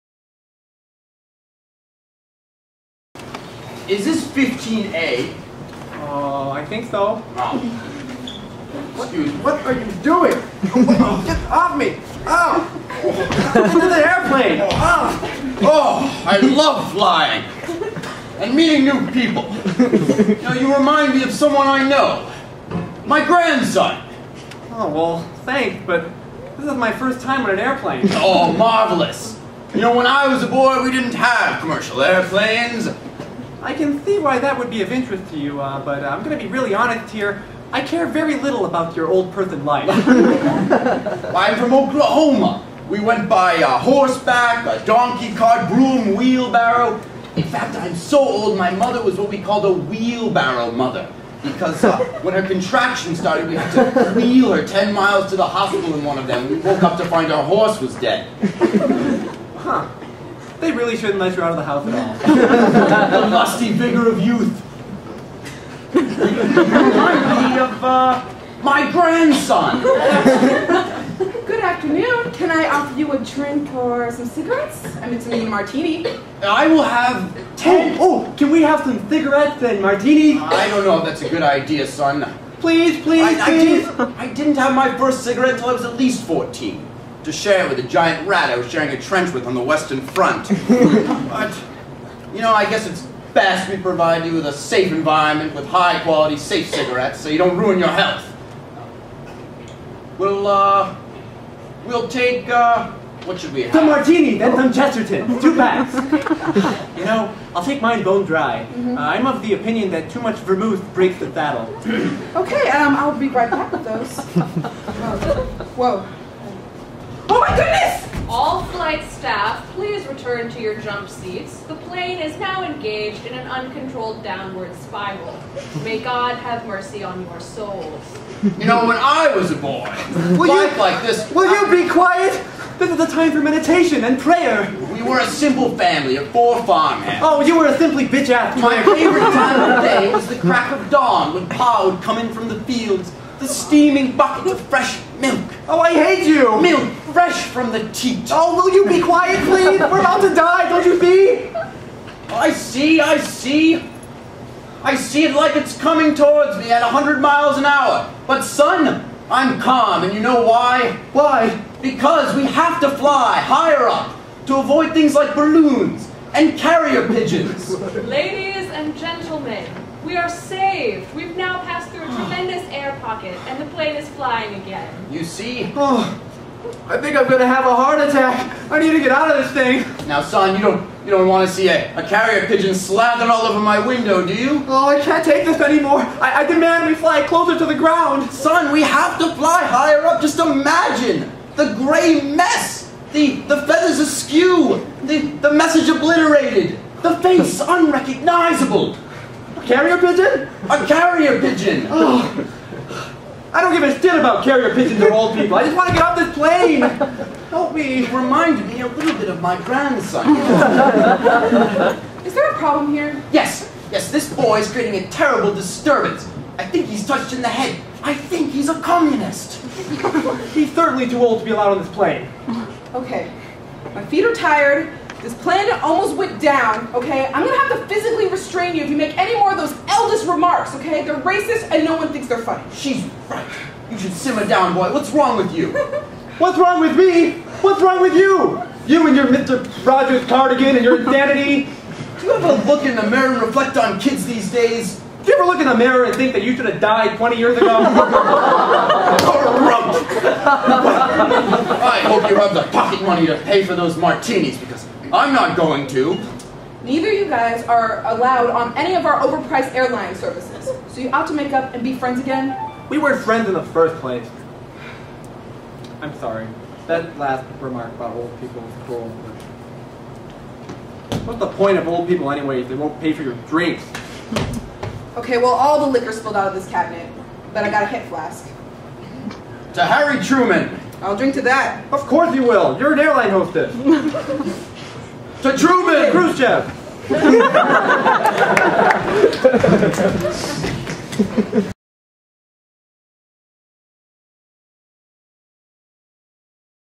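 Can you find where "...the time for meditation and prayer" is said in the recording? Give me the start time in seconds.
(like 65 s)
132 s.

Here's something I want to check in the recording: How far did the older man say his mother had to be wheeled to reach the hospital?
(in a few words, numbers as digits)
10 miles.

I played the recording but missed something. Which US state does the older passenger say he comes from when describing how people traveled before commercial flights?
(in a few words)
Oklahoma.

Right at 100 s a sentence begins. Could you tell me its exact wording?
We'll, uh, we'll take, uh, what should we have?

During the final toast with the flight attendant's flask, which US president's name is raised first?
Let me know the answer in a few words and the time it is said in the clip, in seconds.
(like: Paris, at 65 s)
Harry Truman, at 279 s.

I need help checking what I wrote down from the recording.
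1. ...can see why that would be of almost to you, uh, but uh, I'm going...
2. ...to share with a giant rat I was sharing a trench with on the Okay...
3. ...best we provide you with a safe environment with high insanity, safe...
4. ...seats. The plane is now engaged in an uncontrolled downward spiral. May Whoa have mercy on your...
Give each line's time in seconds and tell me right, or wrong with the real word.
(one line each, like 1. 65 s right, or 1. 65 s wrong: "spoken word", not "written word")
1. 33 s wrong: "interest", not "almost"
2. 87 s wrong: "Western", not "Okay"
3. 93 s wrong: "quality", not "insanity"
4. 121 s wrong: "God", not "Whoa".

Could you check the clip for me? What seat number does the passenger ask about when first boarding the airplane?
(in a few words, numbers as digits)
15A.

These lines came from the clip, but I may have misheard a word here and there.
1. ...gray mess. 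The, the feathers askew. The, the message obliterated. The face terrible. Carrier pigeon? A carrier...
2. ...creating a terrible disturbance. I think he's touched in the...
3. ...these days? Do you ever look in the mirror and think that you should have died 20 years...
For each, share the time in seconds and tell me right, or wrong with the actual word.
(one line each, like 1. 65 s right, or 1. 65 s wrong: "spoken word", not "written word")
1. 191 s wrong: "unrecognizable", not "terrible"
2. 214 s right
3. 244 s right.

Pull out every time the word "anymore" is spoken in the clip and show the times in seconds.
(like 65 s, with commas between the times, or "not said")
185 s.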